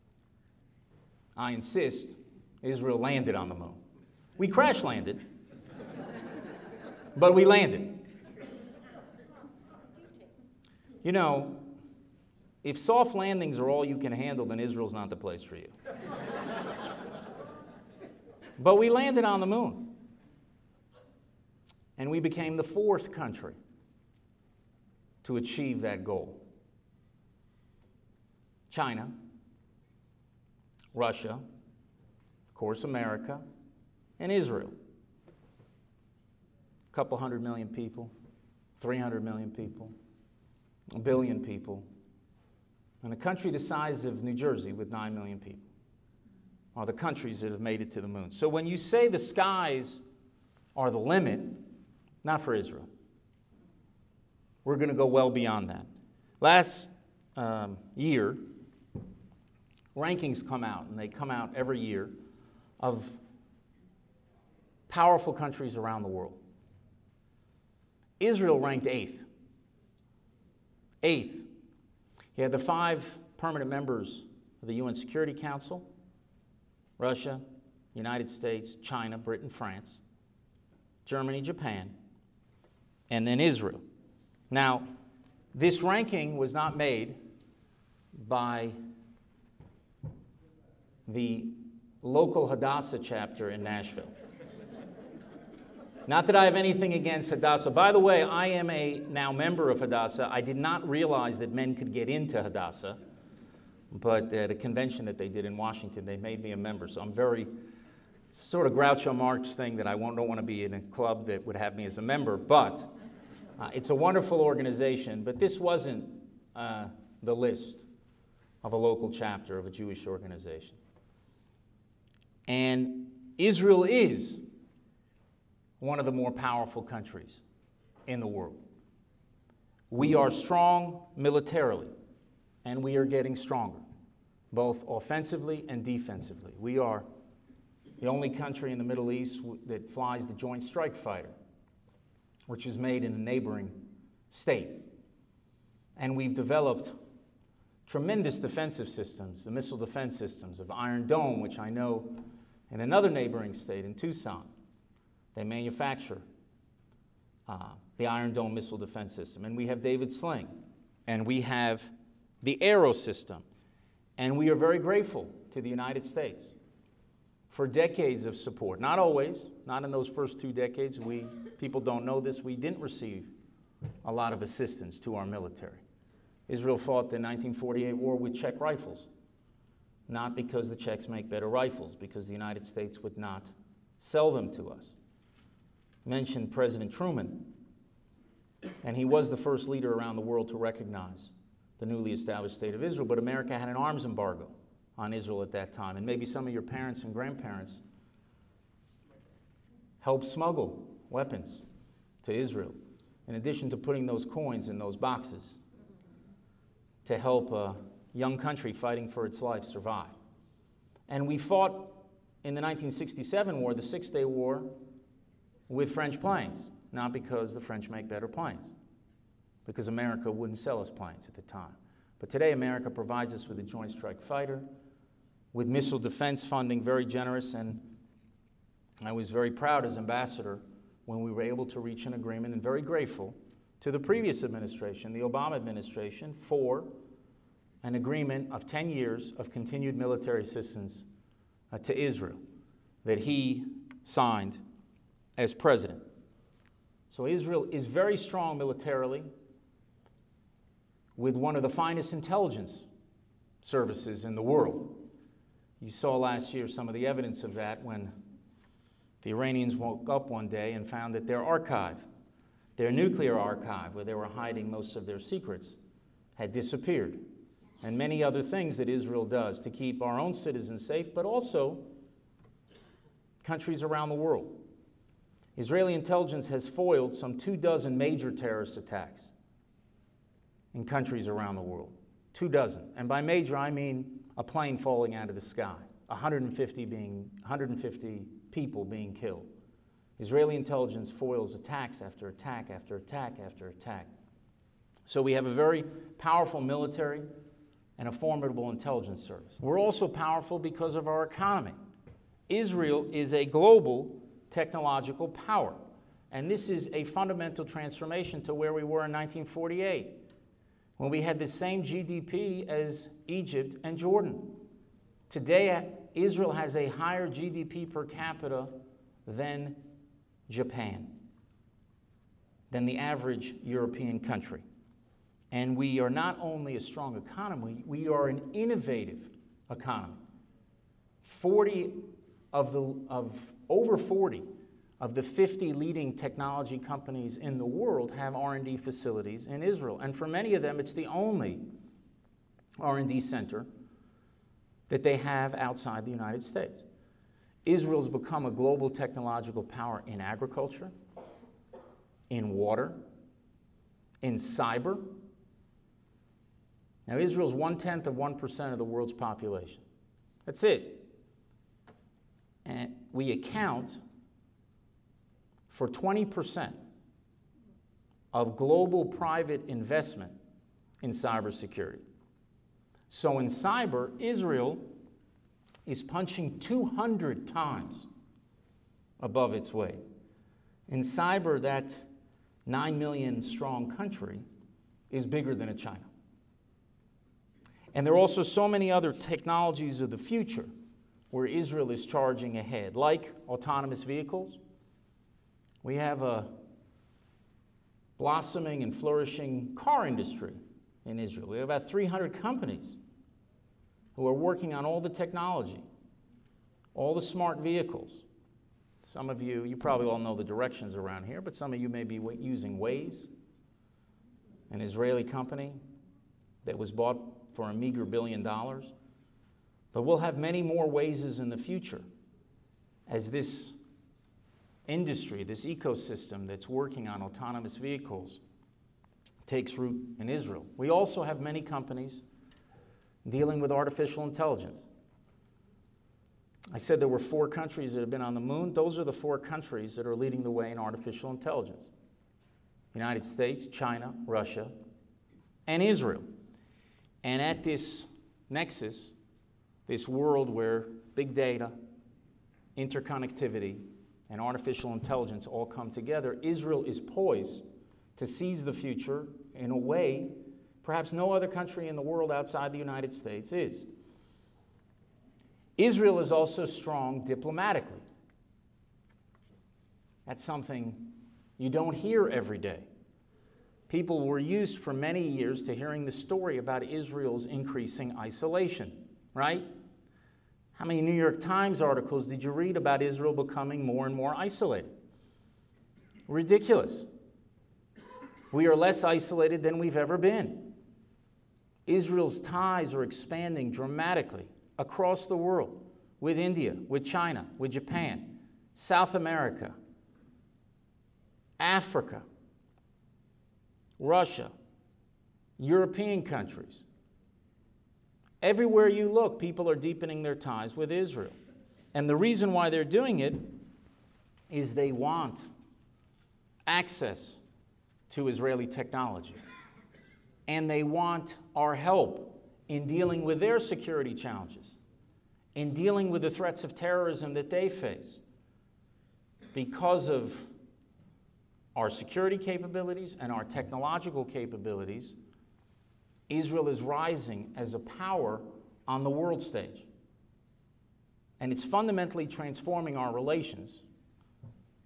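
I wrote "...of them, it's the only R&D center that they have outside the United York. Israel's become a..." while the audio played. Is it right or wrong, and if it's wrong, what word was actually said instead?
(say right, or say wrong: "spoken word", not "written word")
wrong: "States", not "York".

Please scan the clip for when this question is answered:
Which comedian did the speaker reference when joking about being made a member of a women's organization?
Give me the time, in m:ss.
1:48.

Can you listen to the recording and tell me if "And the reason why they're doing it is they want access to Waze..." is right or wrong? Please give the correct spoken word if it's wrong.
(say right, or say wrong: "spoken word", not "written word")
wrong: "Israeli", not "Waze".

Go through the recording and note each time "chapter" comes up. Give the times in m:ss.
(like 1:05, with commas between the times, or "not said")
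1:32, 1:59.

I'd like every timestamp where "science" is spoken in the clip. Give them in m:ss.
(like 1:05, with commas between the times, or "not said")
not said.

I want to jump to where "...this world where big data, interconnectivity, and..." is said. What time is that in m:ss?
7:29.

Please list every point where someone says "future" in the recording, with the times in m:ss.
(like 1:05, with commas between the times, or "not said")
6:30, 7:01, 7:38.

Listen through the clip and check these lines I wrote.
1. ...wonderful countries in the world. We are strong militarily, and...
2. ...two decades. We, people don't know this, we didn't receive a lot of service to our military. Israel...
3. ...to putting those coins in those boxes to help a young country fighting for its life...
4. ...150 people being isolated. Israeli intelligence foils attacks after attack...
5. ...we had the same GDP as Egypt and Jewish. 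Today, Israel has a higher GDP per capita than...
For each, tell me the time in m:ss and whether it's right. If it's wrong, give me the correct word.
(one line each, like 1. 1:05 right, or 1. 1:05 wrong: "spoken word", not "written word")
1. 2:06 wrong: "powerful", not "wonderful"
2. 2:50 wrong: "assistance", not "service"
3. 3:23 right
4. 4:47 wrong: "killed", not "isolated"
5. 5:11 wrong: "Jordan", not "Jewish".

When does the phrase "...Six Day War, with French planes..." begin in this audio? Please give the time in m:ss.
3:33.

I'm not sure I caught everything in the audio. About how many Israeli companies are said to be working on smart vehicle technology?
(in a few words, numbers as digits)
300.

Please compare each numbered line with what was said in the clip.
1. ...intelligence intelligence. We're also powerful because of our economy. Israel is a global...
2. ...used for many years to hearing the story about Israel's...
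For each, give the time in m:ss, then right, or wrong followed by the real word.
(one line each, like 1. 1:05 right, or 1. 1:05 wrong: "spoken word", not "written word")
1. 4:58 wrong: "service", not "intelligence"
2. 7:54 right.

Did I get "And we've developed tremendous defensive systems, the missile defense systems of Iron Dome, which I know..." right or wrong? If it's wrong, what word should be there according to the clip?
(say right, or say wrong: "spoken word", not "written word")
right.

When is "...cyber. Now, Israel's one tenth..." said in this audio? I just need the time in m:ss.
5:54.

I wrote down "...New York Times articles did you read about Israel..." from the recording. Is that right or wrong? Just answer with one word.
right.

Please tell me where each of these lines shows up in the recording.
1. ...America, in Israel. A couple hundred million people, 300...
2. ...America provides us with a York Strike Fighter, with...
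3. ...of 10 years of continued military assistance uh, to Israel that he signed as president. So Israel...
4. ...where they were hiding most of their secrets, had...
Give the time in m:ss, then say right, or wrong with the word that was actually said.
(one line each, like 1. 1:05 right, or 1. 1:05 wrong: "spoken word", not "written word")
1. 0:32 right
2. 3:42 wrong: "Joint", not "York"
3. 3:58 right
4. 4:23 right.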